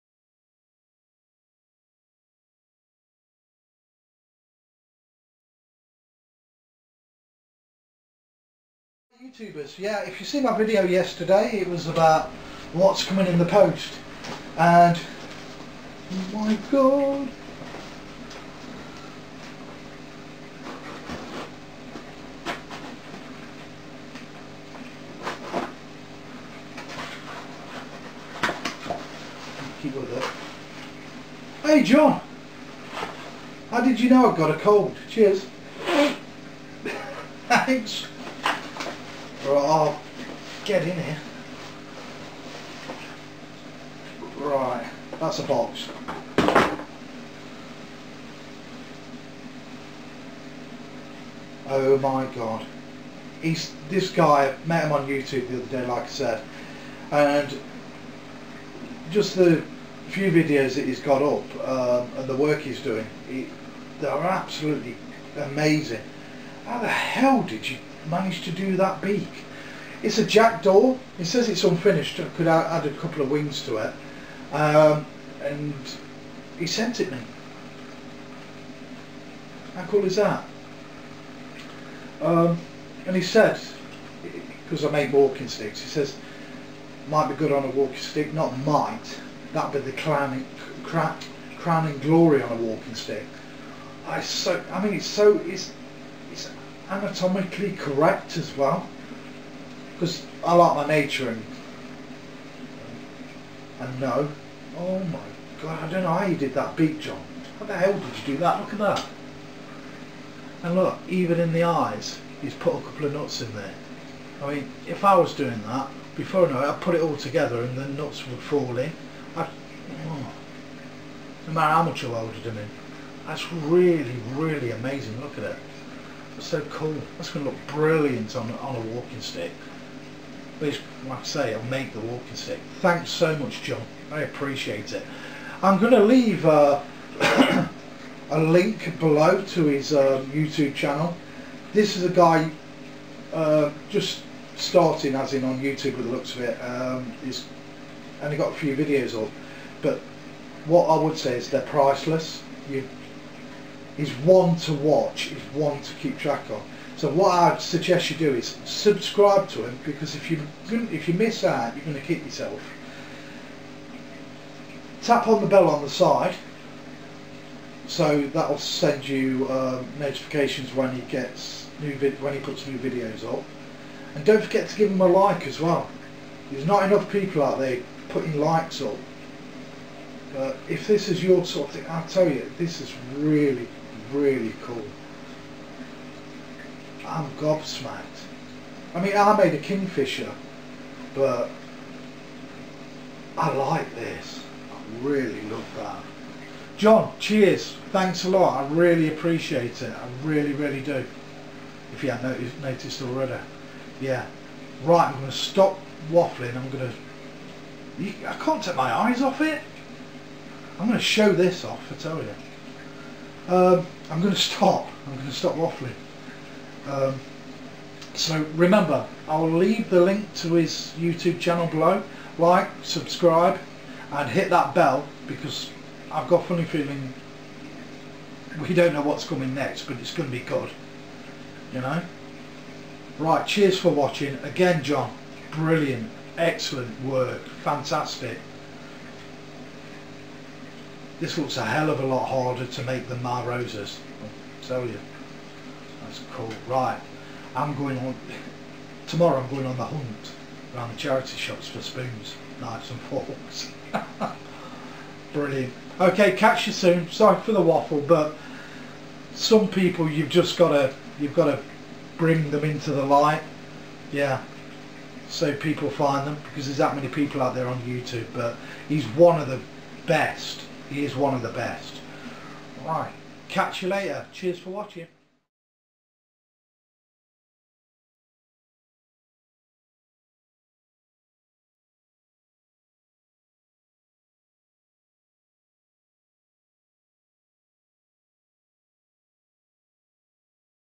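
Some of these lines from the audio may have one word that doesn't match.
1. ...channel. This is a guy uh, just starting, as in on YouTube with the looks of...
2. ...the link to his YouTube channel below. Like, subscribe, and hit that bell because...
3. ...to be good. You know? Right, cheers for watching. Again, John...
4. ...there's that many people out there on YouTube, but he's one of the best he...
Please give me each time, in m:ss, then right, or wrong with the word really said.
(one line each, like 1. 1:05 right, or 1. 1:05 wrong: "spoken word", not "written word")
1. 2:20 right
2. 3:39 right
3. 3:50 right
4. 4:26 right.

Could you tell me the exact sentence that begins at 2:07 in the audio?
That's going to look brilliant on, on a walking stick.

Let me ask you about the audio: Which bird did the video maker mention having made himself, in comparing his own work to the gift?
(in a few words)
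Kingfisher.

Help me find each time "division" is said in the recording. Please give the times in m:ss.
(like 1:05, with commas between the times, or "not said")
not said.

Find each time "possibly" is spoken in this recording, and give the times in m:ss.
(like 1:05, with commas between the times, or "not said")
not said.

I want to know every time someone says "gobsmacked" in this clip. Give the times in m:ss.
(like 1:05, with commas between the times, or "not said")
3:07.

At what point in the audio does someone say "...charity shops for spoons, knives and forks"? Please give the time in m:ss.
4:10.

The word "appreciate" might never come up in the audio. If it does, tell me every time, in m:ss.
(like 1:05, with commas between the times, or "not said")
2:14, 3:19.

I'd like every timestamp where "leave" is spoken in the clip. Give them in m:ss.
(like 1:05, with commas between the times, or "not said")
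2:16, 3:39.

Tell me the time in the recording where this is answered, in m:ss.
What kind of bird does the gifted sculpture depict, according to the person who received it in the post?
1:10.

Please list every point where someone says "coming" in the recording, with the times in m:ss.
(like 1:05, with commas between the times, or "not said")
0:13, 3:49.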